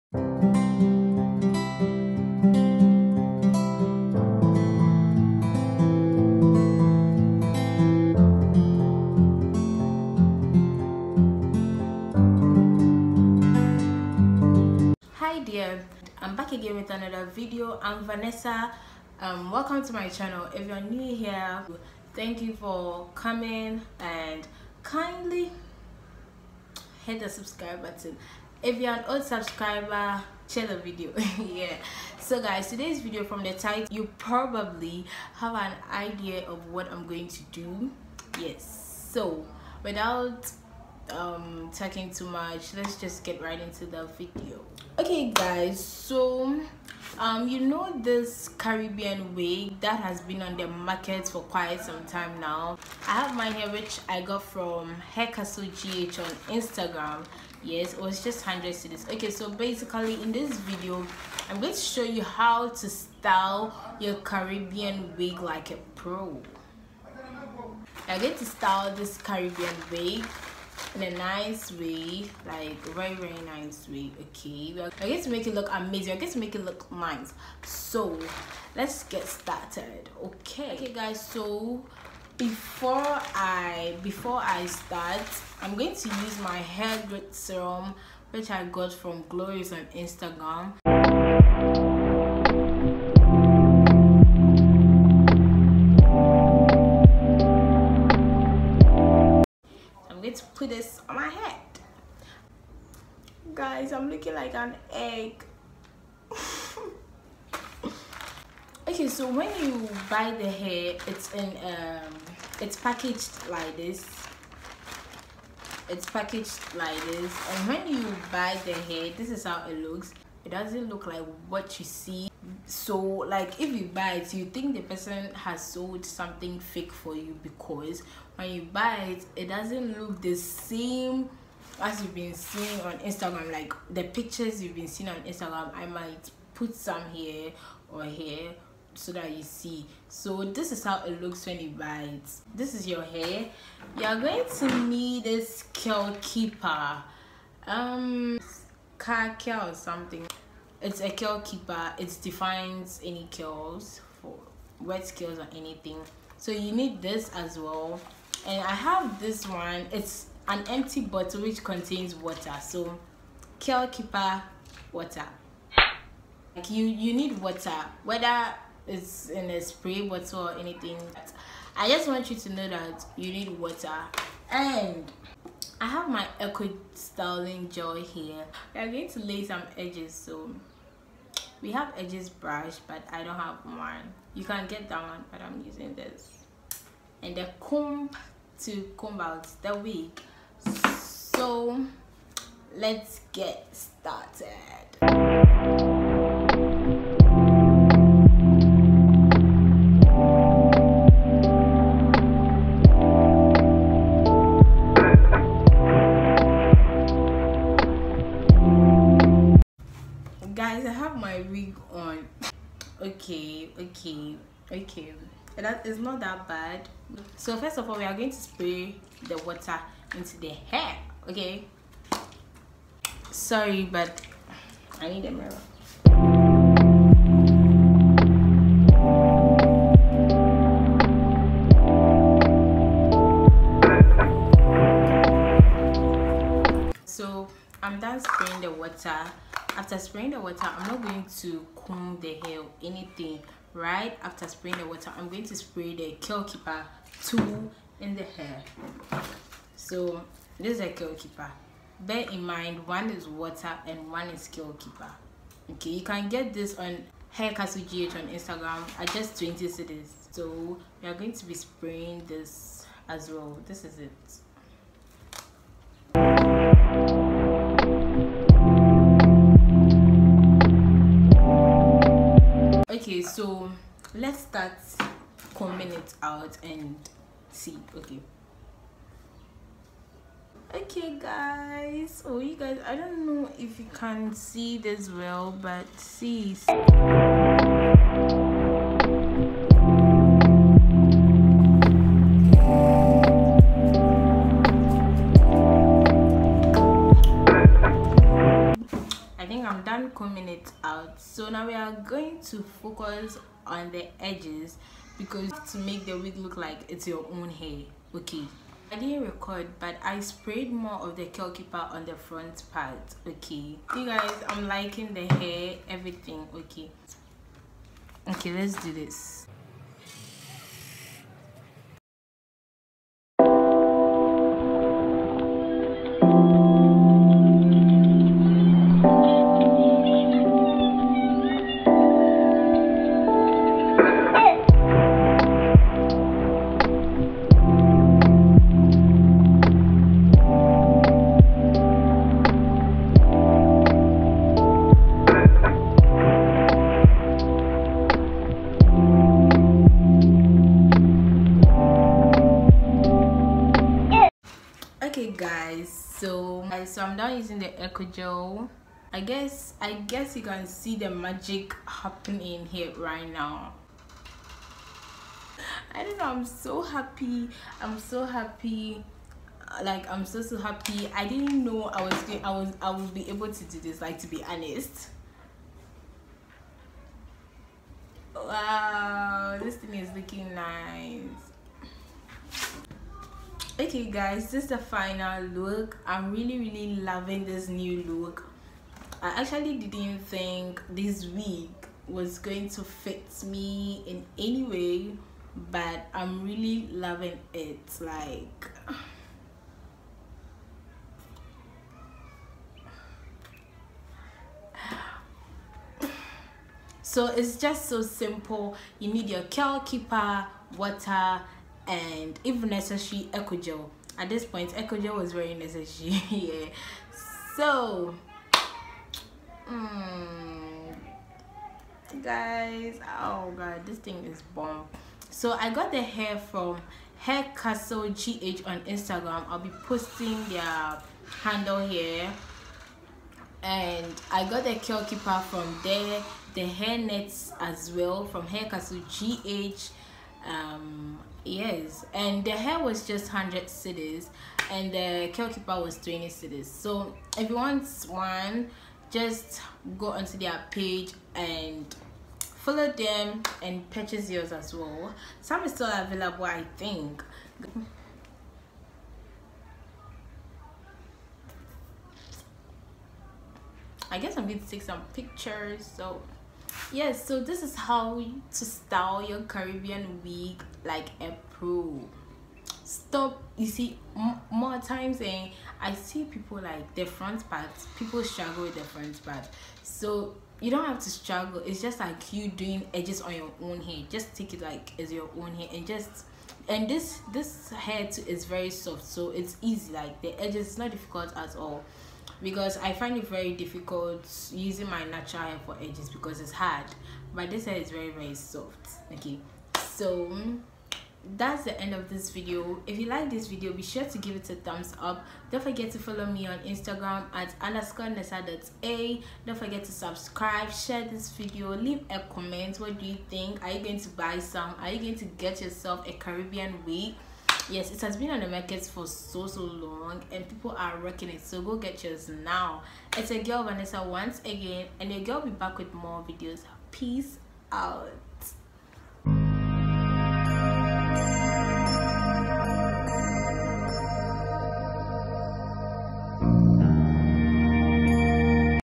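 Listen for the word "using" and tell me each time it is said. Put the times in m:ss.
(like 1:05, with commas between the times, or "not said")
3:05, 5:57, 8:14.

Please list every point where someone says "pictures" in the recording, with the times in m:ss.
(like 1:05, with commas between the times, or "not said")
2:14, 7:45.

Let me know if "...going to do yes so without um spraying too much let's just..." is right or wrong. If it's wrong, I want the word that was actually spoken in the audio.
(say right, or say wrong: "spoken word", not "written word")
wrong: "talking", not "spraying".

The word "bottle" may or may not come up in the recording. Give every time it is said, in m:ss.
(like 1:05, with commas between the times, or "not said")
2:41, 2:50.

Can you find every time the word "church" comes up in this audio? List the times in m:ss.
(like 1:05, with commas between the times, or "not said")
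not said.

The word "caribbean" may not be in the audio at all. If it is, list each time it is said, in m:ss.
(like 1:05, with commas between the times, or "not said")
0:48, 1:04, 1:09, 7:49, 8:36.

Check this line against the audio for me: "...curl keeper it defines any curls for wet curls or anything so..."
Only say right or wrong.
right.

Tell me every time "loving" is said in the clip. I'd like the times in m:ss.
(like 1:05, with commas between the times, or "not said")
6:26, 6:36.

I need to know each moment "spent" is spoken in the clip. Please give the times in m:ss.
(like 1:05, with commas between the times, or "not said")
not said.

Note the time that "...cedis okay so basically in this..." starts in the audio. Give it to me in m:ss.
0:58.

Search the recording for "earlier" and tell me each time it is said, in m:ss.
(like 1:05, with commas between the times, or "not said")
not said.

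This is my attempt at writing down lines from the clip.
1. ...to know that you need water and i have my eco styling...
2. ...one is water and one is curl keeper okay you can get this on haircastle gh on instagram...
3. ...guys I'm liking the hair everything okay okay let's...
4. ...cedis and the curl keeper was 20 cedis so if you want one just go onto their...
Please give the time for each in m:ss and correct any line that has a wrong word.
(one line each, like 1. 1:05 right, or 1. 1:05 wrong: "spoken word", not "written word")
1. 2:52 right
2. 4:12 right
3. 5:14 right
4. 7:23 right.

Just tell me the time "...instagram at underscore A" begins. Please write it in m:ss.
8:26.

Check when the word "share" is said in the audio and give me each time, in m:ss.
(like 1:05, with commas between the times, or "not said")
0:30, 8:30.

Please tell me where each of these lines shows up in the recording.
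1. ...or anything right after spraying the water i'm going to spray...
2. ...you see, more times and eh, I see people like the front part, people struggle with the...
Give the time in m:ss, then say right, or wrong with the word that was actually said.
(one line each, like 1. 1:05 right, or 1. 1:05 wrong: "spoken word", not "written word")
1. 4:02 right
2. 7:53 right.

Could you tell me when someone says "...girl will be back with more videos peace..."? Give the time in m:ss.
8:45.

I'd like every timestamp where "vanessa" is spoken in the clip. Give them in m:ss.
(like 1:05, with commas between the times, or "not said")
0:18, 8:43.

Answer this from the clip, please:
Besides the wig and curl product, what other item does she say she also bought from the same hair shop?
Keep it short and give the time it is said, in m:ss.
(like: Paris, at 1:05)
hair nets, at 7:16.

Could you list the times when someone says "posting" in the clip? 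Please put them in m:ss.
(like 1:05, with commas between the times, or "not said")
7:09.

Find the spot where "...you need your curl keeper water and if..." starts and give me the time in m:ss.
6:48.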